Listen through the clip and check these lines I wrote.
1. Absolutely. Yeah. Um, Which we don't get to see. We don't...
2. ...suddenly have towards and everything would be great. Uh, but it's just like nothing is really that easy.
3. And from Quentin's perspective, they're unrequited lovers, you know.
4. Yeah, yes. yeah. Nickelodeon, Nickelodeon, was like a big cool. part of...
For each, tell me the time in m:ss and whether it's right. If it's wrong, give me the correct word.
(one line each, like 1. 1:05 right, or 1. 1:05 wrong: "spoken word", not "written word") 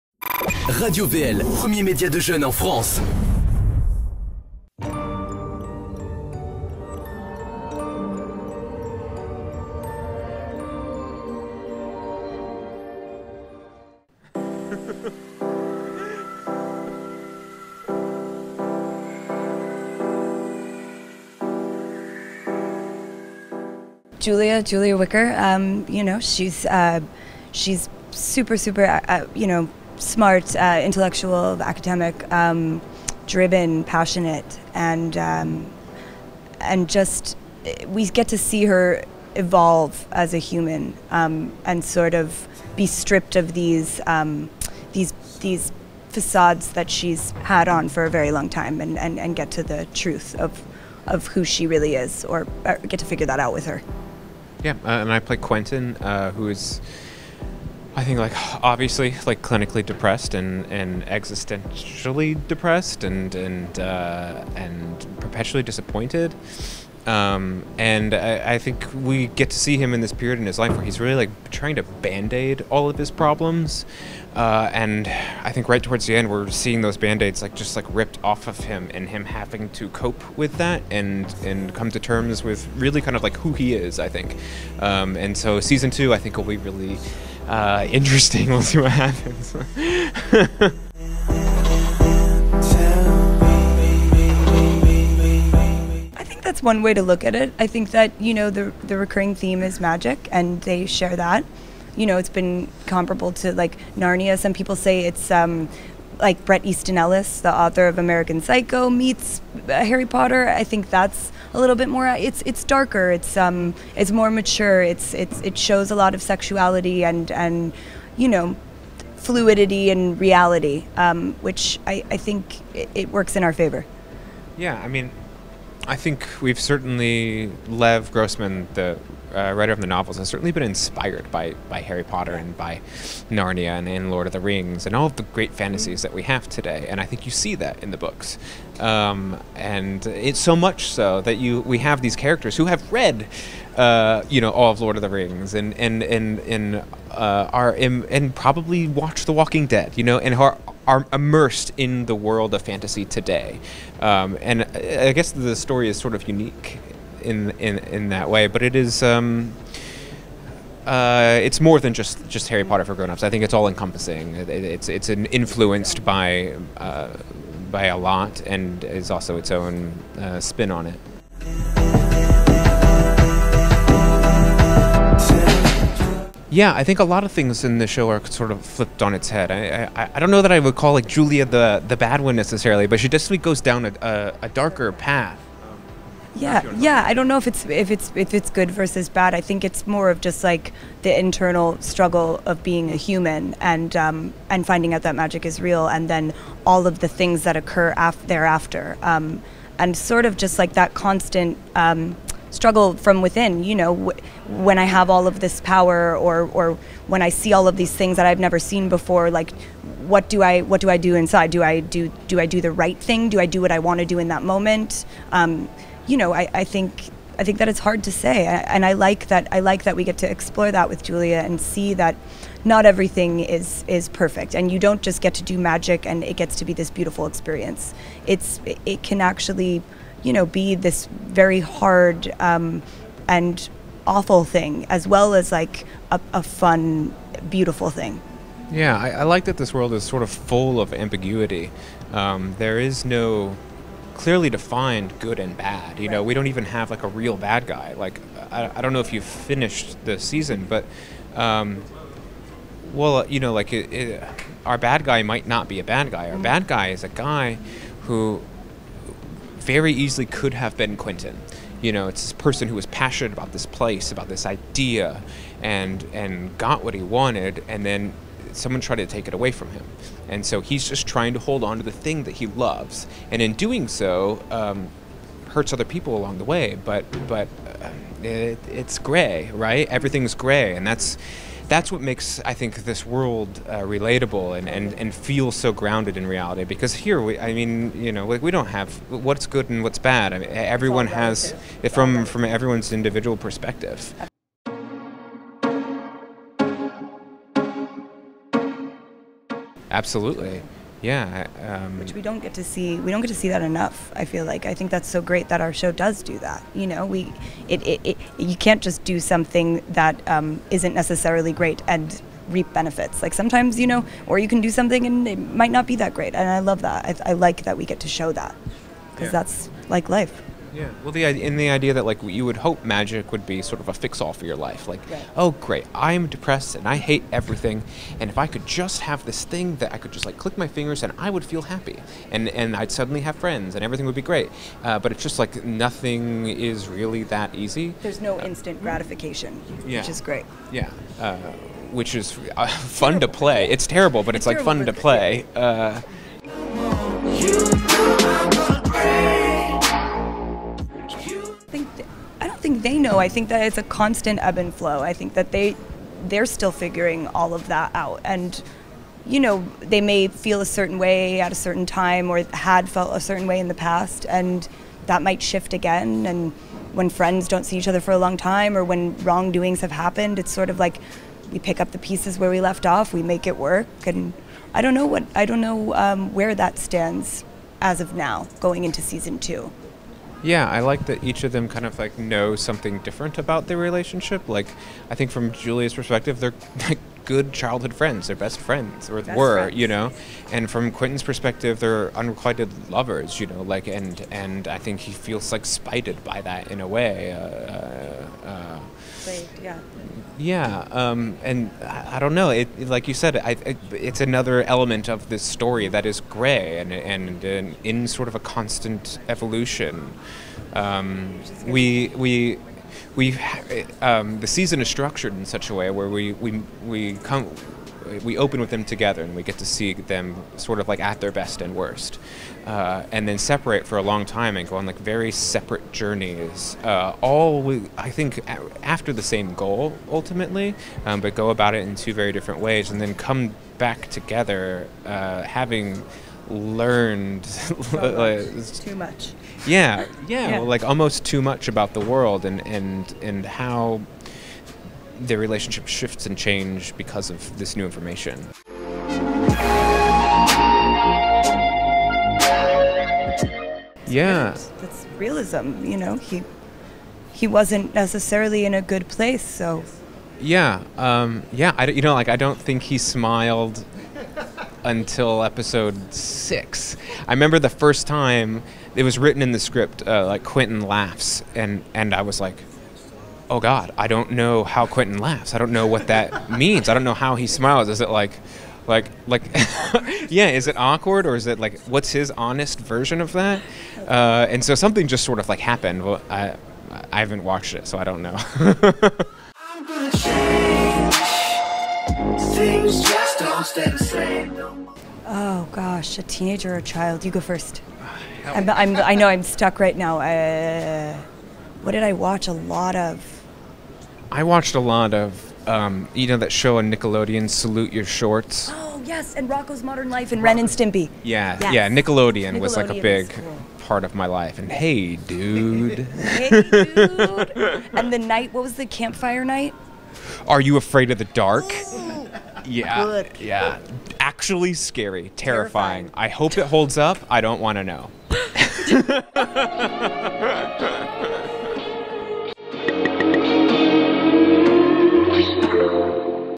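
1. 4:59 right
2. 5:32 wrong: "friends", not "towards"
3. 6:30 right
4. 8:31 right.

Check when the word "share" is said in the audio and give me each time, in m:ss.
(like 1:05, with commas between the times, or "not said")
1:40.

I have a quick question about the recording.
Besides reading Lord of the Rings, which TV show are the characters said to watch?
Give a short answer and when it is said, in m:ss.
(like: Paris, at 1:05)
The Walking Dead, at 2:29.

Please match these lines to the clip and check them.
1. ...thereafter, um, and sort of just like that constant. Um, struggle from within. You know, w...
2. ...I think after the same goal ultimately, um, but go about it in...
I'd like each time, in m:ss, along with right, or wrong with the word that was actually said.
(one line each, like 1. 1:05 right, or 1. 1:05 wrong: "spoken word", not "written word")
1. 3:18 right
2. 7:07 right.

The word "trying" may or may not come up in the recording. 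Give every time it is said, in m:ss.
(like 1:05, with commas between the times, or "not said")
1:11, 4:31.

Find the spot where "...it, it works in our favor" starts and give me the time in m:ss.
2:02.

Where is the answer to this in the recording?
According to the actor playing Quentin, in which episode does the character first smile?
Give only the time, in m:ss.
7:45.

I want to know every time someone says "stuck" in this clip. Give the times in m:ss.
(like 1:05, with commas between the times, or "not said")
8:19.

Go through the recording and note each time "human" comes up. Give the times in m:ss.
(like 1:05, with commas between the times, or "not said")
0:40, 3:12.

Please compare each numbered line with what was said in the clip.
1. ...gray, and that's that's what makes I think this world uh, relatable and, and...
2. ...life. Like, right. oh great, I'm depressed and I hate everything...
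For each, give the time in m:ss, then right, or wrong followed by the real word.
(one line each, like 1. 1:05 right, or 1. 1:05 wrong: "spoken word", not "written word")
1. 4:40 right
2. 5:24 right.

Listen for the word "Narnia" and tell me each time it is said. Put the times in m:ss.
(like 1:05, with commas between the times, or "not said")
1:43, 2:13.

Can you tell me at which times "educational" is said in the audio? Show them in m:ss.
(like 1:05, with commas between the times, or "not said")
not said.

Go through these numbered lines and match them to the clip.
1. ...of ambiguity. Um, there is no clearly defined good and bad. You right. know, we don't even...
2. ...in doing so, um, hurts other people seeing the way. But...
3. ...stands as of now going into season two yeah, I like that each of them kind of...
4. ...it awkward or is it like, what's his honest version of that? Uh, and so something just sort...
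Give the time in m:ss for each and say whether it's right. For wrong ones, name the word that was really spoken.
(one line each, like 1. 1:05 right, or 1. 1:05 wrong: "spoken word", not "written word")
1. 4:00 right
2. 4:33 wrong: "along", not "seeing"
3. 6:16 right
4. 8:00 right.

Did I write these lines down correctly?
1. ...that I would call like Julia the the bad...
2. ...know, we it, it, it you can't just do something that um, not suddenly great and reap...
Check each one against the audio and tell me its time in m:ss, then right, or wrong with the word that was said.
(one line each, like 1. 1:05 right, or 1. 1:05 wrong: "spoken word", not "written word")
1. 3:00 right
2. 5:06 wrong: "necessarily", not "suddenly".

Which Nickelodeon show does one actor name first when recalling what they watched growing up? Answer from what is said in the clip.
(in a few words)
Salute Your Shorts.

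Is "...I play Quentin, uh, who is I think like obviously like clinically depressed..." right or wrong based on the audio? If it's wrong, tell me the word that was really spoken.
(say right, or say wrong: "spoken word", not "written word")
right.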